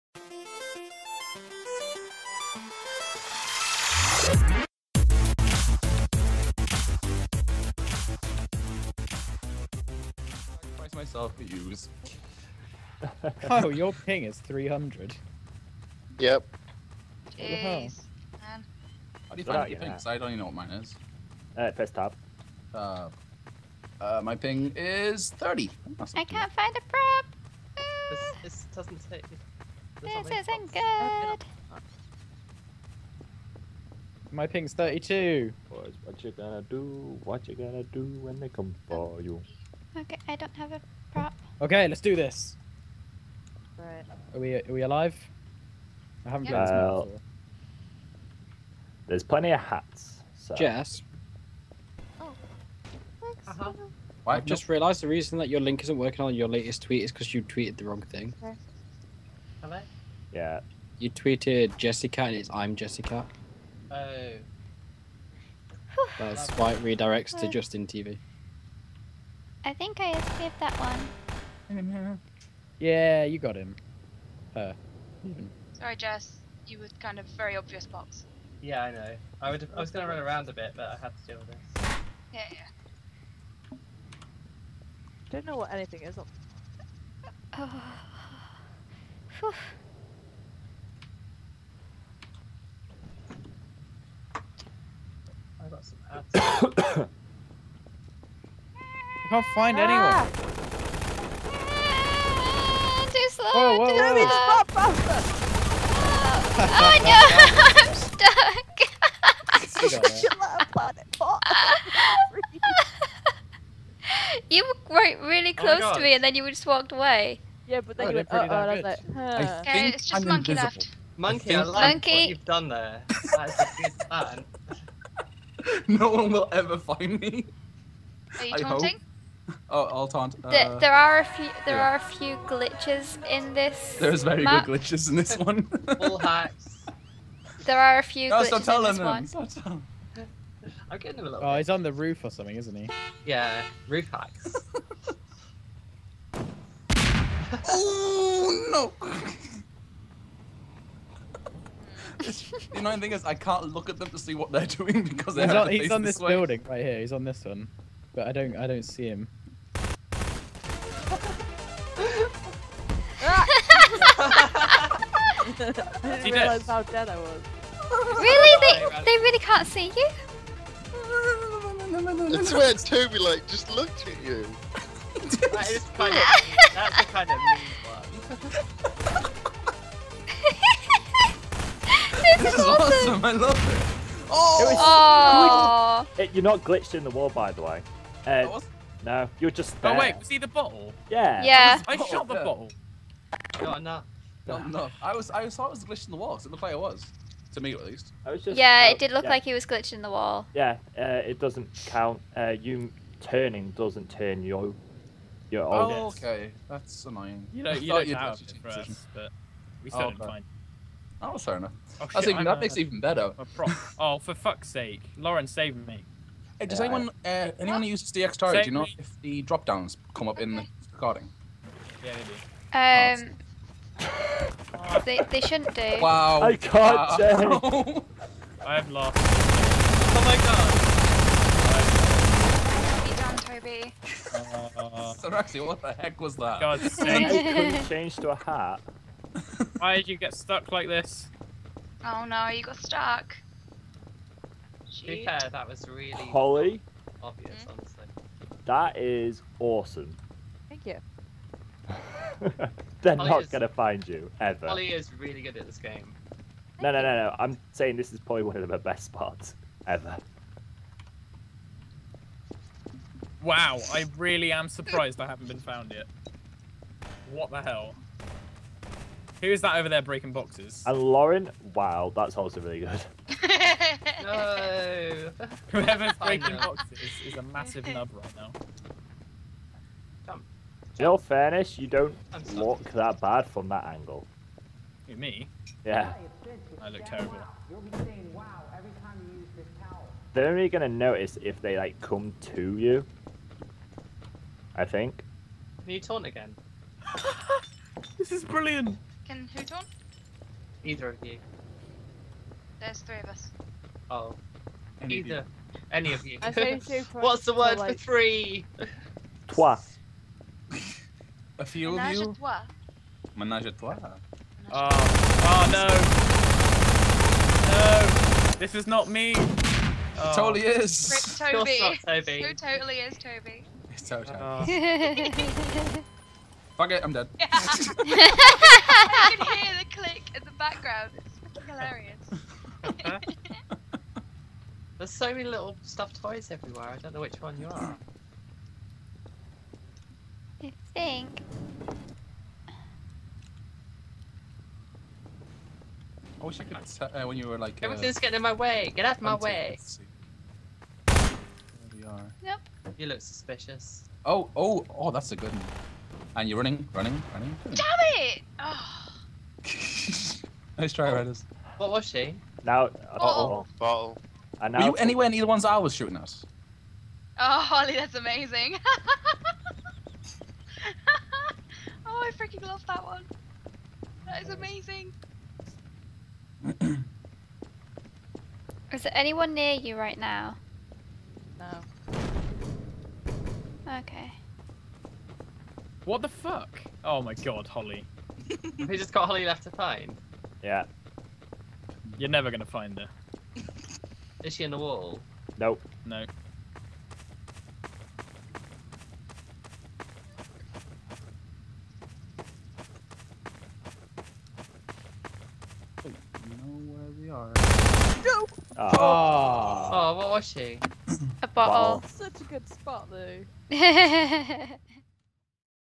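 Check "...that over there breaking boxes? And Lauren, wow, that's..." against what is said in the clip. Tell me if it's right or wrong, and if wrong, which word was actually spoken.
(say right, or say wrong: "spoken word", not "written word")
right.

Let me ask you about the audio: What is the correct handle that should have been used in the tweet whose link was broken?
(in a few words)
ImJessicat.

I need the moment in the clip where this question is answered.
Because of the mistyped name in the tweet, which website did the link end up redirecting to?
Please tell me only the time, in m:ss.
1:07.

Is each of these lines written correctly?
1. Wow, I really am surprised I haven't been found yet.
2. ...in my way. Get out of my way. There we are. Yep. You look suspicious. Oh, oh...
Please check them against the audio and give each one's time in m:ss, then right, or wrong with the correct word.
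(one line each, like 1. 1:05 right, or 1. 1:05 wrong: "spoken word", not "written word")
1. 4:23 right
2. 5:48 right.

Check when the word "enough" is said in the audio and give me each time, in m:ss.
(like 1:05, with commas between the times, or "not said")
3:14, 3:31.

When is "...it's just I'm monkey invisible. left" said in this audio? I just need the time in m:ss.
1:59.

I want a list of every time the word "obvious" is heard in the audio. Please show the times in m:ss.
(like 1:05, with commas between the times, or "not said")
1:17, 4:07.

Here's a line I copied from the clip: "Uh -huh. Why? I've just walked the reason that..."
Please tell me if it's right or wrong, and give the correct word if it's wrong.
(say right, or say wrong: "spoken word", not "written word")
wrong: "realised", not "walked".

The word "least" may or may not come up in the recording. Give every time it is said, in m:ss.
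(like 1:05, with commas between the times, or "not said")
3:17.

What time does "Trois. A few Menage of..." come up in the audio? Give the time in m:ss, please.
5:09.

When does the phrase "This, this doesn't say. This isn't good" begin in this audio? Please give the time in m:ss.
0:28.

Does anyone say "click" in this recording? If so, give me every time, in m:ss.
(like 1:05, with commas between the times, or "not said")
5:29.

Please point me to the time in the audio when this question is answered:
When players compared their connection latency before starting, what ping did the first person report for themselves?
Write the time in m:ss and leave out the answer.
0:24.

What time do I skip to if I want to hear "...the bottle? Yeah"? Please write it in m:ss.
3:10.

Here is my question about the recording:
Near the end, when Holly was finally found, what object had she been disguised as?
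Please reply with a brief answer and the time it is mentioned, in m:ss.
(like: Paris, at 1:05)
A bottle, at 6:51.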